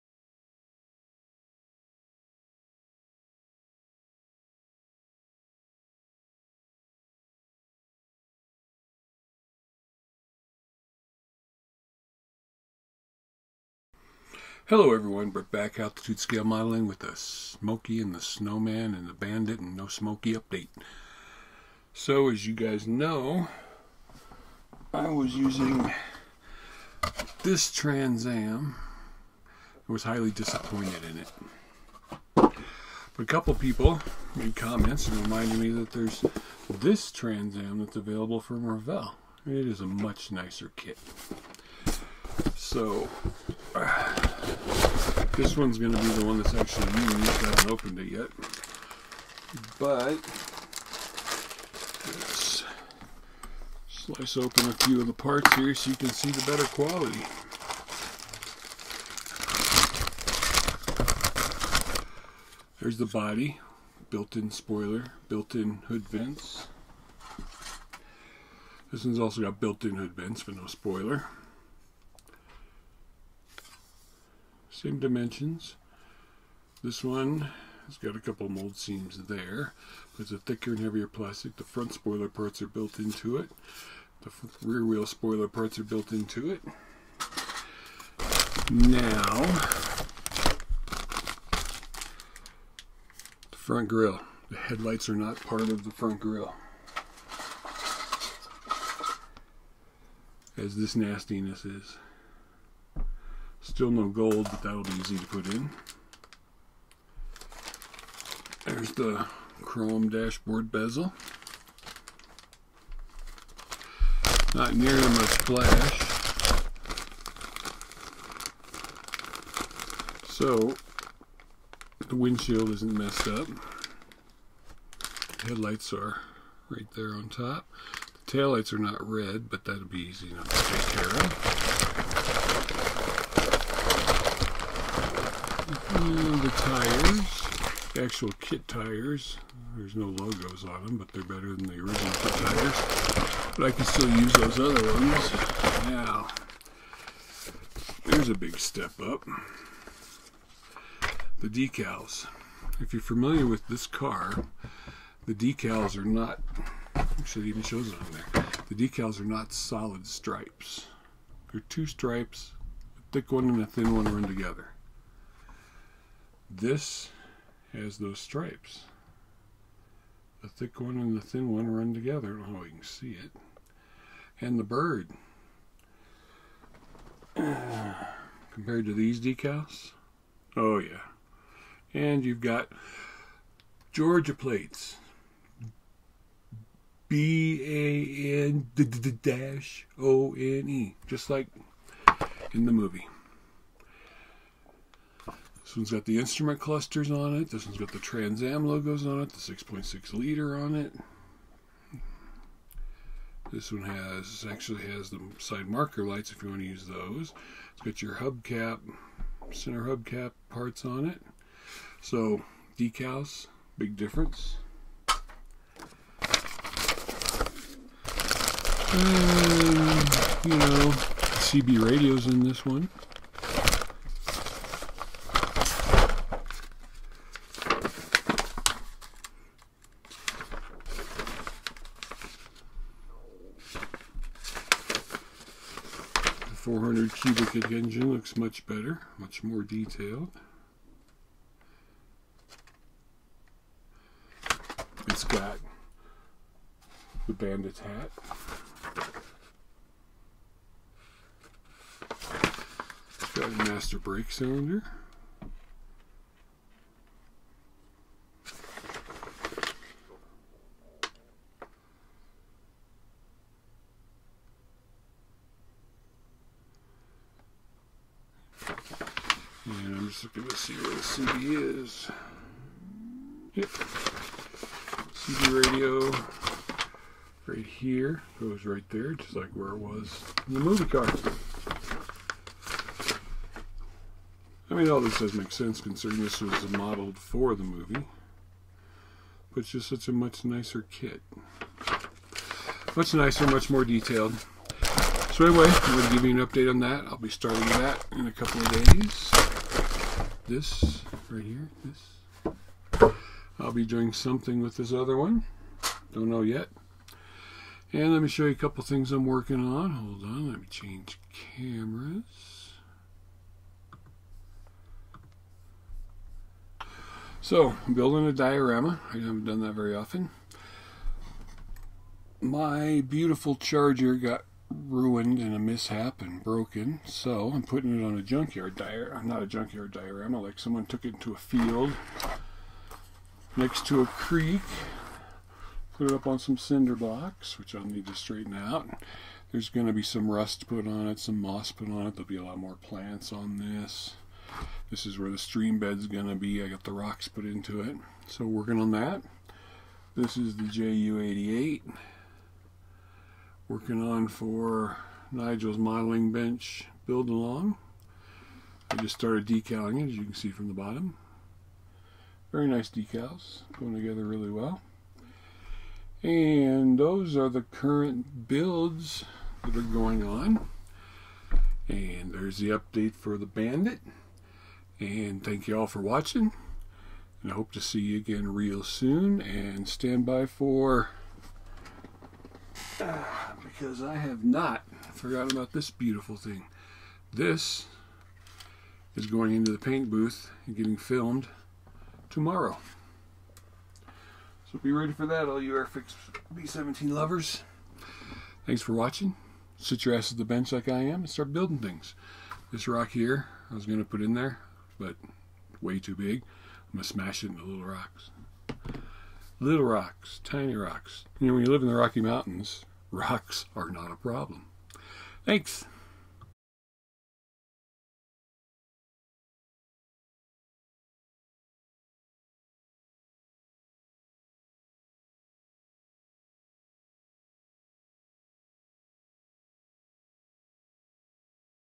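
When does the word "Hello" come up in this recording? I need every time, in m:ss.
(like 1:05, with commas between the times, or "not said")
0:14.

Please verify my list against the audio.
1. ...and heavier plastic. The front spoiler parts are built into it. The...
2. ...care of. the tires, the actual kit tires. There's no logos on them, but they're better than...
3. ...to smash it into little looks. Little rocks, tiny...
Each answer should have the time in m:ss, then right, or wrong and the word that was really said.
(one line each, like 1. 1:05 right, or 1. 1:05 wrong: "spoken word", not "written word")
1. 1:20 right
2. 2:11 right
3. 6:47 wrong: "rocks", not "looks".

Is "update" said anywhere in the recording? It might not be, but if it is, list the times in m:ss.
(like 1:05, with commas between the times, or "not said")
0:20, 4:56, 6:12.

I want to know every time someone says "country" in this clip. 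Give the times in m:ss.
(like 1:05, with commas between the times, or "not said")
not said.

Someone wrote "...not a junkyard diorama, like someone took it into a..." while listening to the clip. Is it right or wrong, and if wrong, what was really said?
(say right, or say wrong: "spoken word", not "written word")
right.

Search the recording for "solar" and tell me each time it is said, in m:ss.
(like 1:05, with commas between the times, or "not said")
not said.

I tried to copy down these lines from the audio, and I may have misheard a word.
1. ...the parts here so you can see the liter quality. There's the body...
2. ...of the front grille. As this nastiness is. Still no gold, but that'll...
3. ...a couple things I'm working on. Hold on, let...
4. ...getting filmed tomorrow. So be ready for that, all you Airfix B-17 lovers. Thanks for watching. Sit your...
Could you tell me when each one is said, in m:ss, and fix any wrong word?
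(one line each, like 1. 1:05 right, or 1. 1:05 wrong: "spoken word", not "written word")
1. 0:55 wrong: "better", not "liter"
2. 1:35 right
3. 5:08 right
4. 6:30 right.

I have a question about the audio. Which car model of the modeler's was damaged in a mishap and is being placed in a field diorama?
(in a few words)
Charger.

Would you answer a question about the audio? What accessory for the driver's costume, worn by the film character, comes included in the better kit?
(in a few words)
bandit hat.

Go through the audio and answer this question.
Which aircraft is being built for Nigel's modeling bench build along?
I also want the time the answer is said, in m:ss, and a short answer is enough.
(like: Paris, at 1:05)
JU88, at 5:50.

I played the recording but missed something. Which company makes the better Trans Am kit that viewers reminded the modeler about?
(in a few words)
Revell.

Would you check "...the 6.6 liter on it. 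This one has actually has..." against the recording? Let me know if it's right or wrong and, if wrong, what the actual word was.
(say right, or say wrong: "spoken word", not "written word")
right.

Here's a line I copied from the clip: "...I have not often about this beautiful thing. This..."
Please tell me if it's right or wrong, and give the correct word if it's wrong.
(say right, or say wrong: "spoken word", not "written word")
wrong: "forgotten", not "often".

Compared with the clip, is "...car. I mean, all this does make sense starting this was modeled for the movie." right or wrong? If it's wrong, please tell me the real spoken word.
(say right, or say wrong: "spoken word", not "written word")
wrong: "considering", not "starting".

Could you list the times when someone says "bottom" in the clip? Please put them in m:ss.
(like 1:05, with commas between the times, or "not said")
6:00.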